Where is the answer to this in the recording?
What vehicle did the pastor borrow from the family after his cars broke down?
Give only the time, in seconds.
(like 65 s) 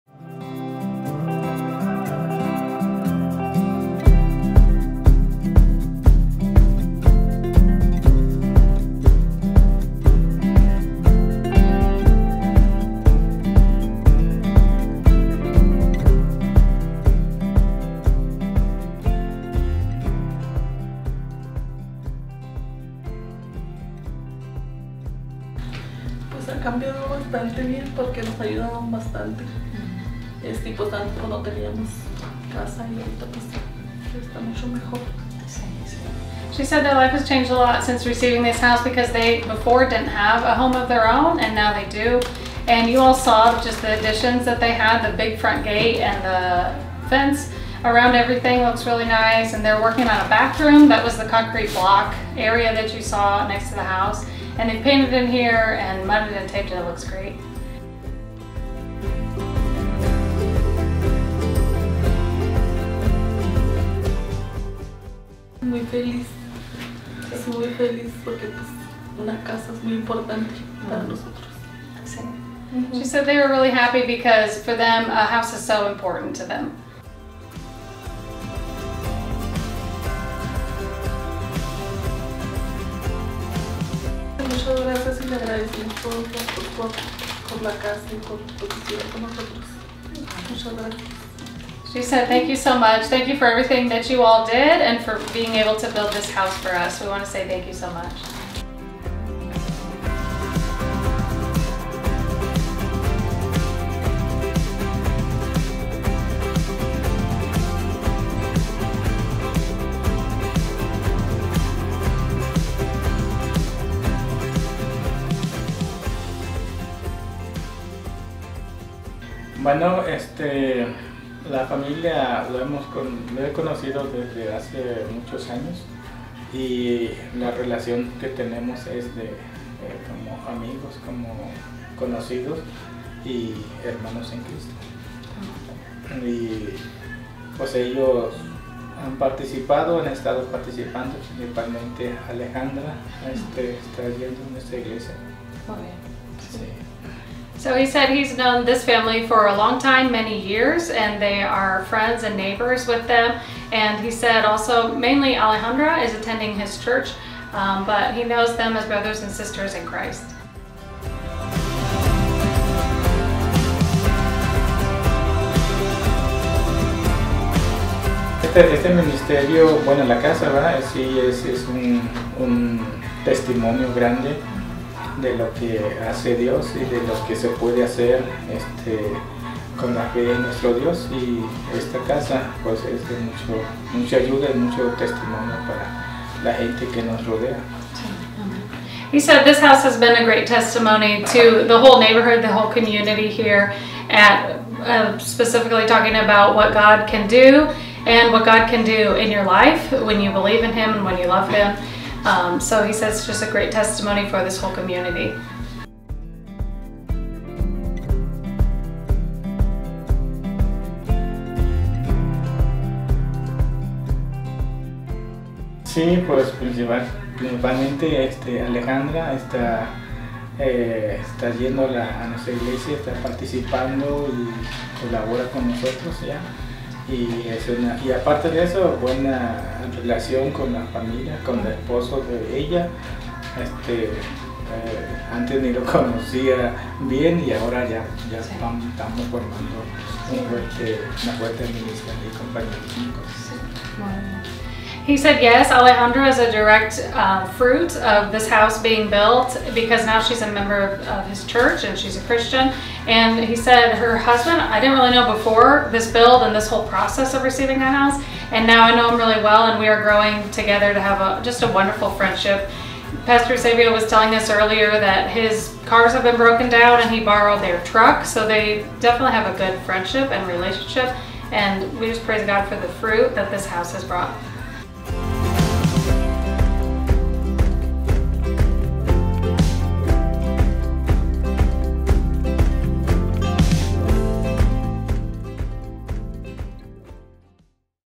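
267 s.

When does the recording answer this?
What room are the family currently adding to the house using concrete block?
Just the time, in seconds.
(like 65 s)
50 s.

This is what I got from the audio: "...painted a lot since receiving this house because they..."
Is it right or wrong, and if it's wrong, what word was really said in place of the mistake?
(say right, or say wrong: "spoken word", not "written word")
wrong: "changed", not "painted".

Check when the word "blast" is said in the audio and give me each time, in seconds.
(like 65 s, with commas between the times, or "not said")
not said.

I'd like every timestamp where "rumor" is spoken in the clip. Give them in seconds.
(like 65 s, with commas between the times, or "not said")
not said.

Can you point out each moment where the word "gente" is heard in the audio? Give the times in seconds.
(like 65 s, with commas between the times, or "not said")
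186 s.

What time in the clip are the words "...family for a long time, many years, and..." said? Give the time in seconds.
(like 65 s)
148 s.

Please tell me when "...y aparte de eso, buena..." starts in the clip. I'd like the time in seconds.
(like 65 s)
228 s.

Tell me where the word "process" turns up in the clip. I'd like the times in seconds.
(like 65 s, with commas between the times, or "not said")
256 s.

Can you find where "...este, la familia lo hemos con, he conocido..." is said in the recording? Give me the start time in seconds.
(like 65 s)
120 s.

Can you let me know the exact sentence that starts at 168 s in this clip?
Este, este ministerio, bueno, la casa, ¿verdad?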